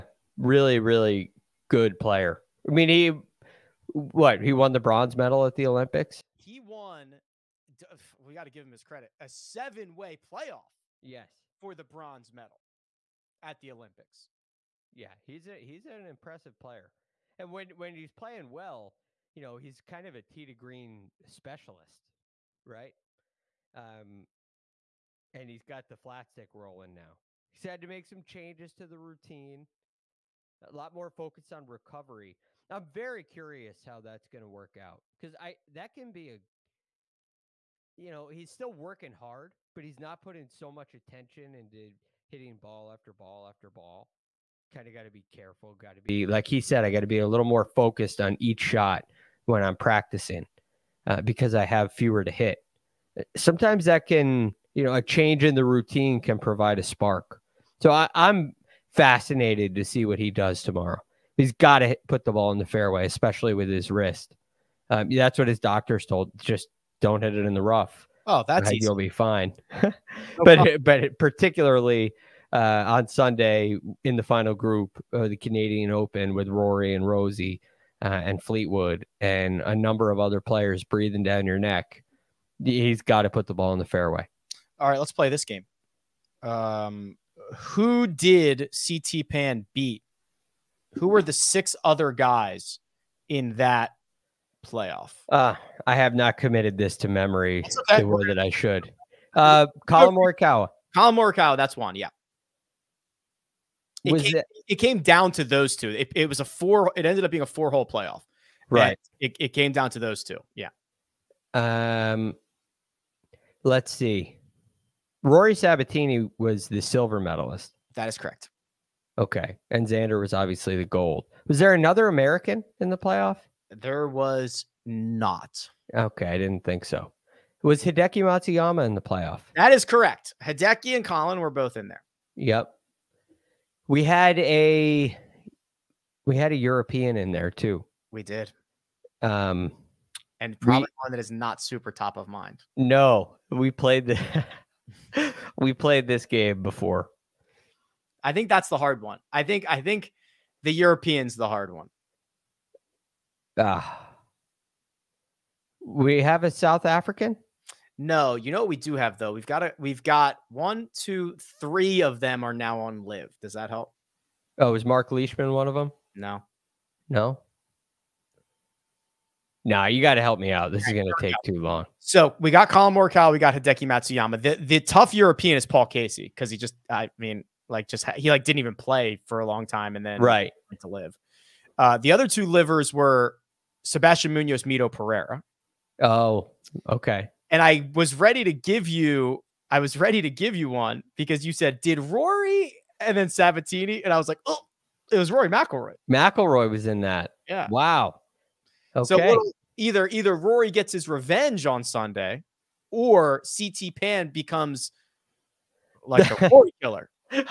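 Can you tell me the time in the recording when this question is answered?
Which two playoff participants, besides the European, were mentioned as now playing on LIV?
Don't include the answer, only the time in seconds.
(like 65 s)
183 s.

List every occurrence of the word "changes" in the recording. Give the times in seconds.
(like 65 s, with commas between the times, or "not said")
28 s, 55 s.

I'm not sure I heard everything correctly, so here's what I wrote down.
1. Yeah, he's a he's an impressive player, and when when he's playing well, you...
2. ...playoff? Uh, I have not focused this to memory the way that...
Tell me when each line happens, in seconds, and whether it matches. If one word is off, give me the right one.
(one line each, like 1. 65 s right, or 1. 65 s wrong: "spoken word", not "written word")
1. 14 s right
2. 94 s wrong: "committed", not "focused".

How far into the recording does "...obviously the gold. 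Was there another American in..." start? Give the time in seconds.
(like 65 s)
120 s.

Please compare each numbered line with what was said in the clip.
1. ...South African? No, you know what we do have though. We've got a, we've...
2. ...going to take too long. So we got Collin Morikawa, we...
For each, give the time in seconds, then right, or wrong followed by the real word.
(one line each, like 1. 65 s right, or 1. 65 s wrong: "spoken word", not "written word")
1. 156 s right
2. 170 s right.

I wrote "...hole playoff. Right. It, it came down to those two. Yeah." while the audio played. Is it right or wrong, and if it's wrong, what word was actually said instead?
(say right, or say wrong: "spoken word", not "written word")
right.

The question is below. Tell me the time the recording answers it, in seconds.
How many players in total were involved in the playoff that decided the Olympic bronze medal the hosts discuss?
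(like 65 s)
9 s.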